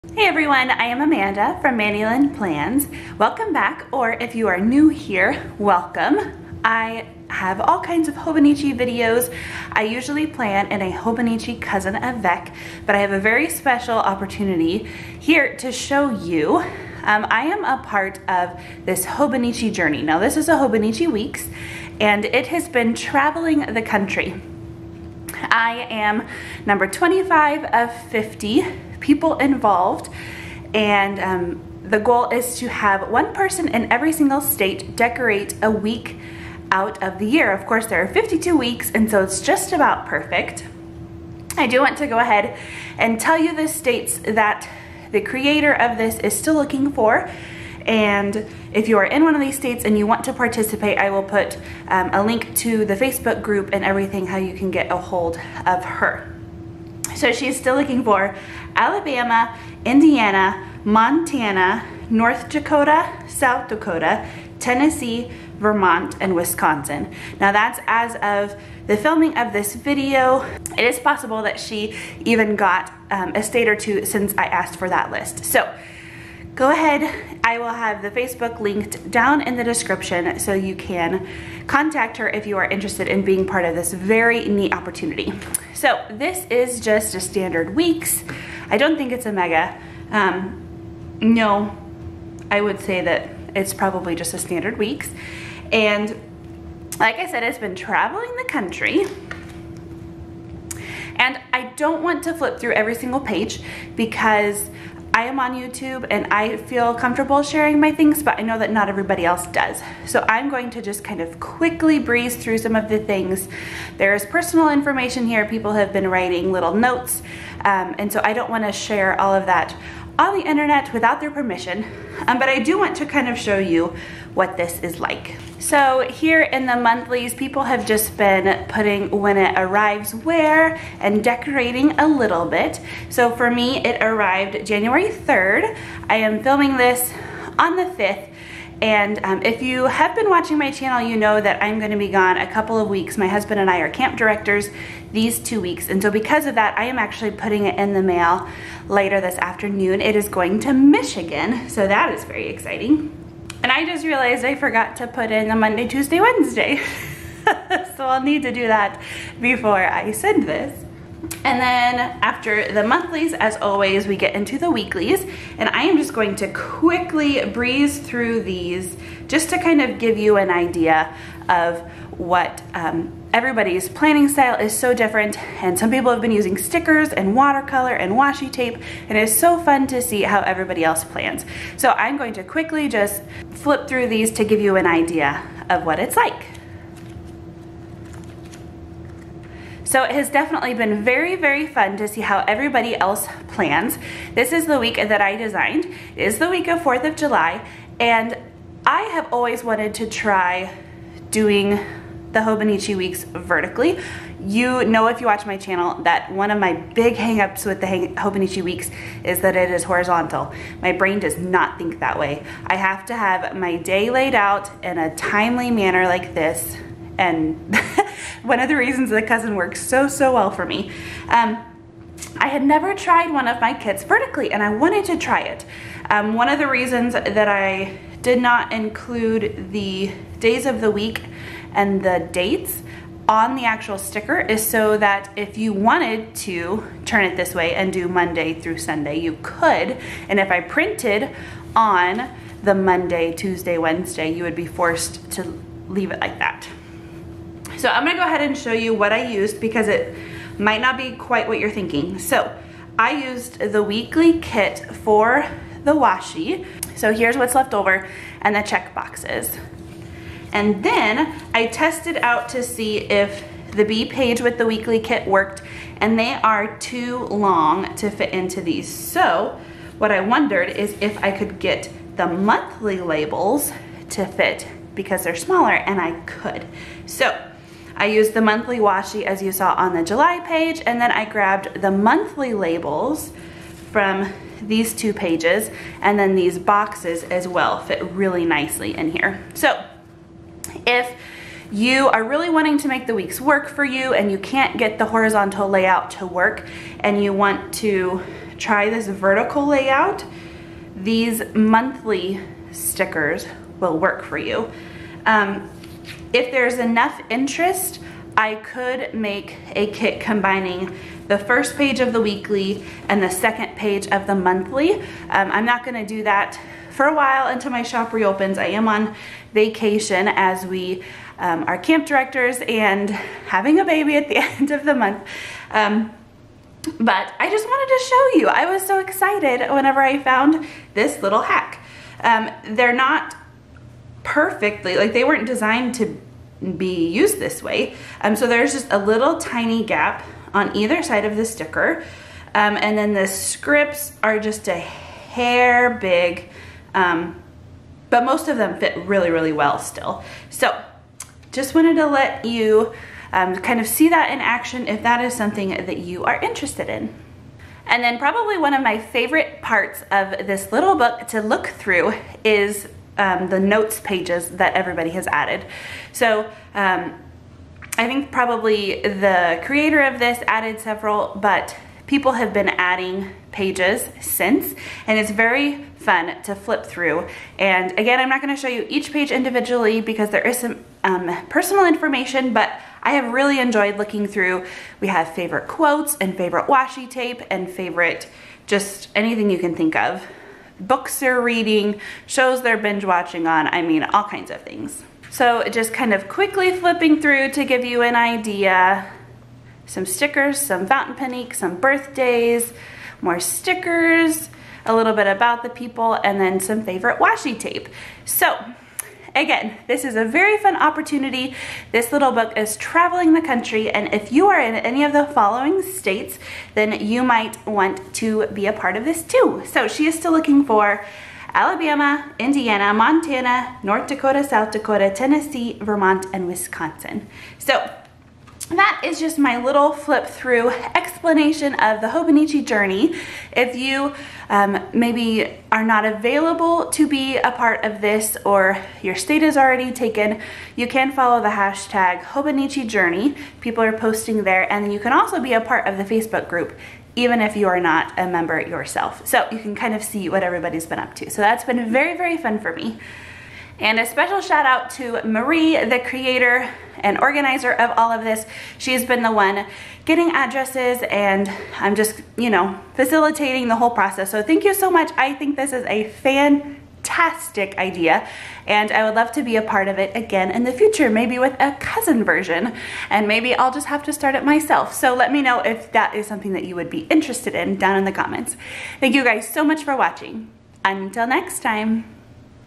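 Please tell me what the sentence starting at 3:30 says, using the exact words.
My brain does not think that way.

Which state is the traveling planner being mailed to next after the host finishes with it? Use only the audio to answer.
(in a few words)
Michigan.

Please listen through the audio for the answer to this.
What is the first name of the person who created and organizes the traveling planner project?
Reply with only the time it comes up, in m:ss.
7:35.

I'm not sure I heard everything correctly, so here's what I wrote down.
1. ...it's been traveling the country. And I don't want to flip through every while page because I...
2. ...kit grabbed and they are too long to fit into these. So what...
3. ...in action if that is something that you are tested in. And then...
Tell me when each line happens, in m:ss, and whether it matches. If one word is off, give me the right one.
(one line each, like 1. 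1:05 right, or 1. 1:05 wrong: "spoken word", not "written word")
1. 1:37 wrong: "single", not "while"
2. 4:24 wrong: "worked", not "grabbed"
3. 5:54 wrong: "interested", not "tested".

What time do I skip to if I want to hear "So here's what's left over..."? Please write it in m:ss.
4:16.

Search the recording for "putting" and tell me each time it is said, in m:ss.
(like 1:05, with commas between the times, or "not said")
2:08, 2:27.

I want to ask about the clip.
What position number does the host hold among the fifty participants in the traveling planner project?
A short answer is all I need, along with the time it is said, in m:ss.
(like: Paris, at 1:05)
25, at 0:26.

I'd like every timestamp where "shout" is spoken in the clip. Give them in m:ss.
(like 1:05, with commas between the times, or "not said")
7:34.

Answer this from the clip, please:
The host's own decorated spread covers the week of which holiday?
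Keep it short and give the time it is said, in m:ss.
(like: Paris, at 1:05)
4th of July, at 3:16.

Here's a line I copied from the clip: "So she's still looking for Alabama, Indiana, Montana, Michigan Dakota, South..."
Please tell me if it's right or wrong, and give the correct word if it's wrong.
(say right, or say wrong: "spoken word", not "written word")
wrong: "North", not "Michigan".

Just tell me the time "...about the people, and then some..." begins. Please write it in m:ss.
6:45.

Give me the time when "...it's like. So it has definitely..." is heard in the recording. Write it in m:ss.
3:05.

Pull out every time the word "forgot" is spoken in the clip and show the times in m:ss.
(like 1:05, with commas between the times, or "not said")
2:34.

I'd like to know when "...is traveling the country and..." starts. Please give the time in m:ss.
6:52.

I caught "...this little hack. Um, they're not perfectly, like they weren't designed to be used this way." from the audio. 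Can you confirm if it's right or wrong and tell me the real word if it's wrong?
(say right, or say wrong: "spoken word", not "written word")
right.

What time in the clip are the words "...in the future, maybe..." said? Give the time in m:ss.
7:50.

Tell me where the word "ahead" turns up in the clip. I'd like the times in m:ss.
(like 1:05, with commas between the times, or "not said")
0:42, 1:16, 4:08.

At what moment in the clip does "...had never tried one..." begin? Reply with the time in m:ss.
3:42.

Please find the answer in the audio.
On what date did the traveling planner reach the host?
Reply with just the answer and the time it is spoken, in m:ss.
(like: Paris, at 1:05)
January 3rd, at 2:14.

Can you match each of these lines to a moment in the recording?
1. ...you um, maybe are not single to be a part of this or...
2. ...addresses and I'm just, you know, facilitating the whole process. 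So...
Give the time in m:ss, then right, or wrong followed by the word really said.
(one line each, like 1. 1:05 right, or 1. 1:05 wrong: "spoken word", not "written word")
1. 7:13 wrong: "available", not "single"
2. 7:40 right.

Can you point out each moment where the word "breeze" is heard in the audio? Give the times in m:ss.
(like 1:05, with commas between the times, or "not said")
1:51, 2:47.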